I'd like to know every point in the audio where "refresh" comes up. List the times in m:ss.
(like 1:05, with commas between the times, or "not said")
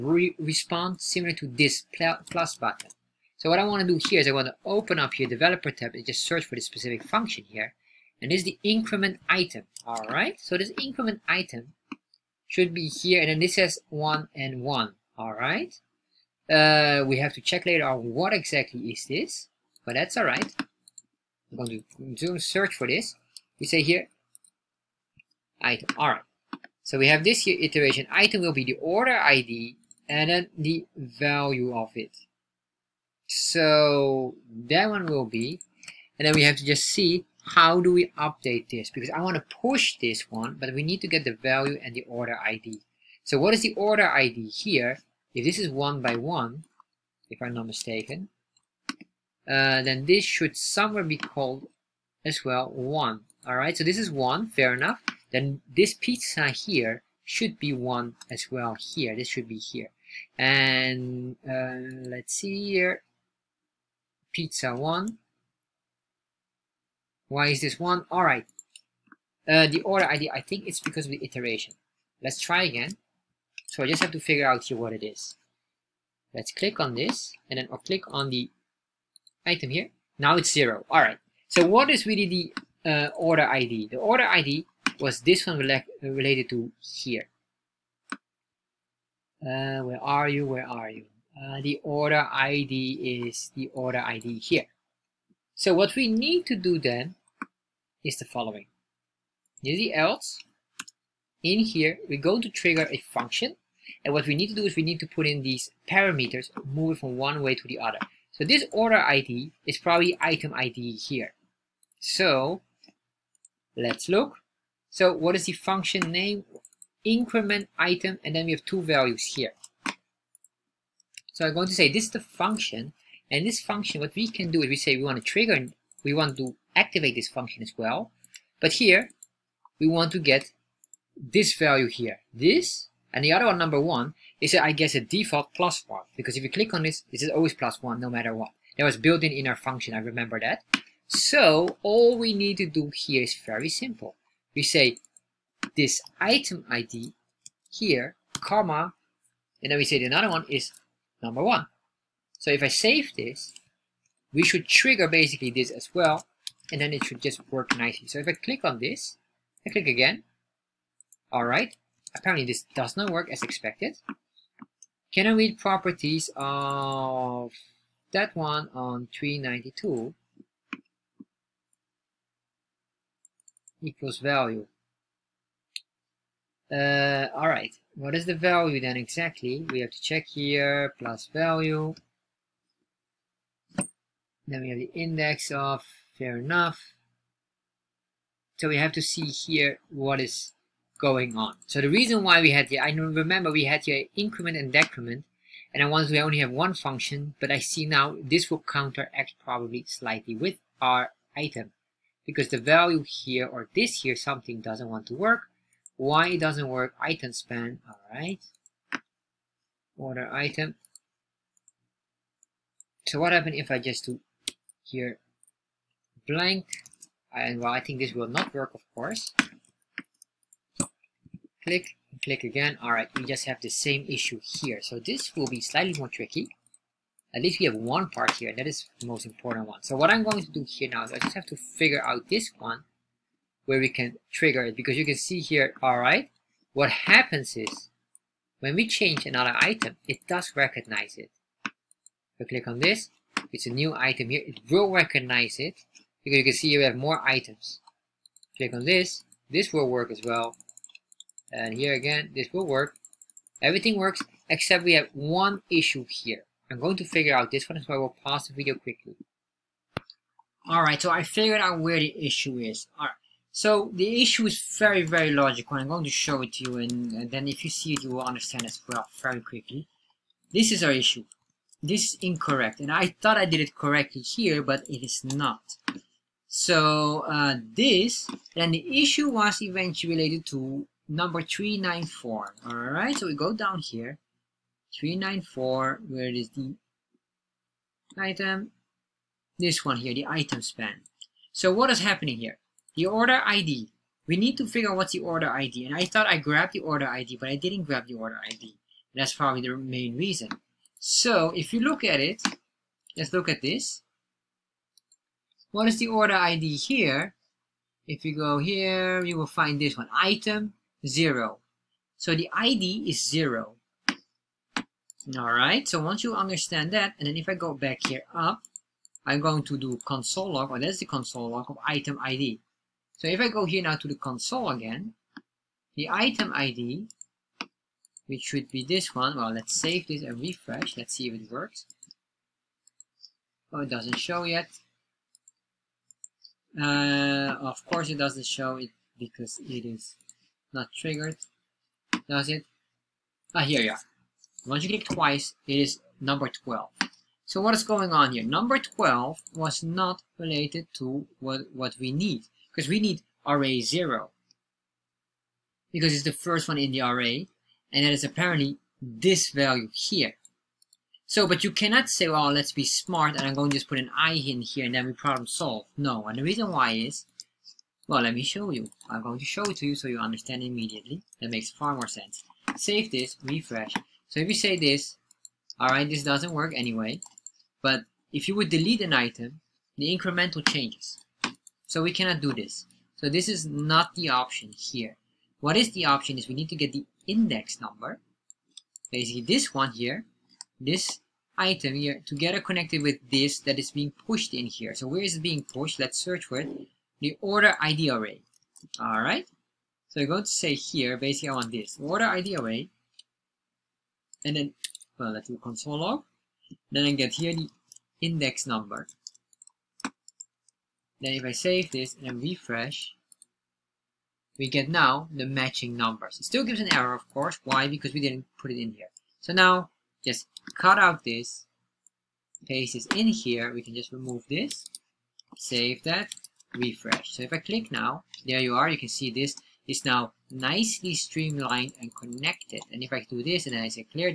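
5:30, 6:13, 6:52, 7:06.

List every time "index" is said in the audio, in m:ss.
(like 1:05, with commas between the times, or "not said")
3:04, 6:27, 6:48.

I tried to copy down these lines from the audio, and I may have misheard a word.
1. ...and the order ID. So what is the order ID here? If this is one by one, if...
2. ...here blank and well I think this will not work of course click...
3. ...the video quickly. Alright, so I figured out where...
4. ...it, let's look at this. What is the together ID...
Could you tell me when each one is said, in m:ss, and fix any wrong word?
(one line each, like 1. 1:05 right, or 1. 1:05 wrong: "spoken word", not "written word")
1. 0:41 right
2. 3:34 right
3. 4:18 right
4. 5:02 wrong: "order", not "together".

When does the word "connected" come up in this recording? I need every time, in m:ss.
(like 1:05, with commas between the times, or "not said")
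6:32, 7:12.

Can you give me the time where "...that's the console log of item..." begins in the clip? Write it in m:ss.
5:20.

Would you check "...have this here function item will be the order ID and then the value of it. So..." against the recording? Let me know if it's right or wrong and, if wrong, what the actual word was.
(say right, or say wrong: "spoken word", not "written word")
wrong: "iteration", not "function".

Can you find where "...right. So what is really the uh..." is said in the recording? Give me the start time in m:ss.
1:21.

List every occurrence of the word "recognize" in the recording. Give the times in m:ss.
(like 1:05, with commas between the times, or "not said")
4:00, 4:04.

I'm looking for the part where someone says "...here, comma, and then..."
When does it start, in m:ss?
2:27.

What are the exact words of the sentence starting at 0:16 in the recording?
Uh, we have to check later on what exactly is this, but that's all right.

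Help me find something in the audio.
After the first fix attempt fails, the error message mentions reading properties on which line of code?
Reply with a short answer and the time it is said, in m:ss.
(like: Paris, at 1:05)
392, at 2:49.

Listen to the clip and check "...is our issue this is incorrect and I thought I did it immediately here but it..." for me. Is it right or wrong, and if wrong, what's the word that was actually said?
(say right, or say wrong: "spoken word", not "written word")
wrong: "correctly", not "immediately".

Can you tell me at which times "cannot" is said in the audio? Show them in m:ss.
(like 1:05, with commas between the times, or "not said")
6:01, 6:22.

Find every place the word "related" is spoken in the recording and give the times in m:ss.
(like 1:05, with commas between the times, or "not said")
1:26, 4:40, 5:50.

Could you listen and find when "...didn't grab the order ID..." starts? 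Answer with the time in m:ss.
4:57.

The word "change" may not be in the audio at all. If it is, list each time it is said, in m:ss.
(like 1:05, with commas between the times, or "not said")
3:58, 6:20.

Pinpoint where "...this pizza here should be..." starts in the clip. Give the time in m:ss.
0:55.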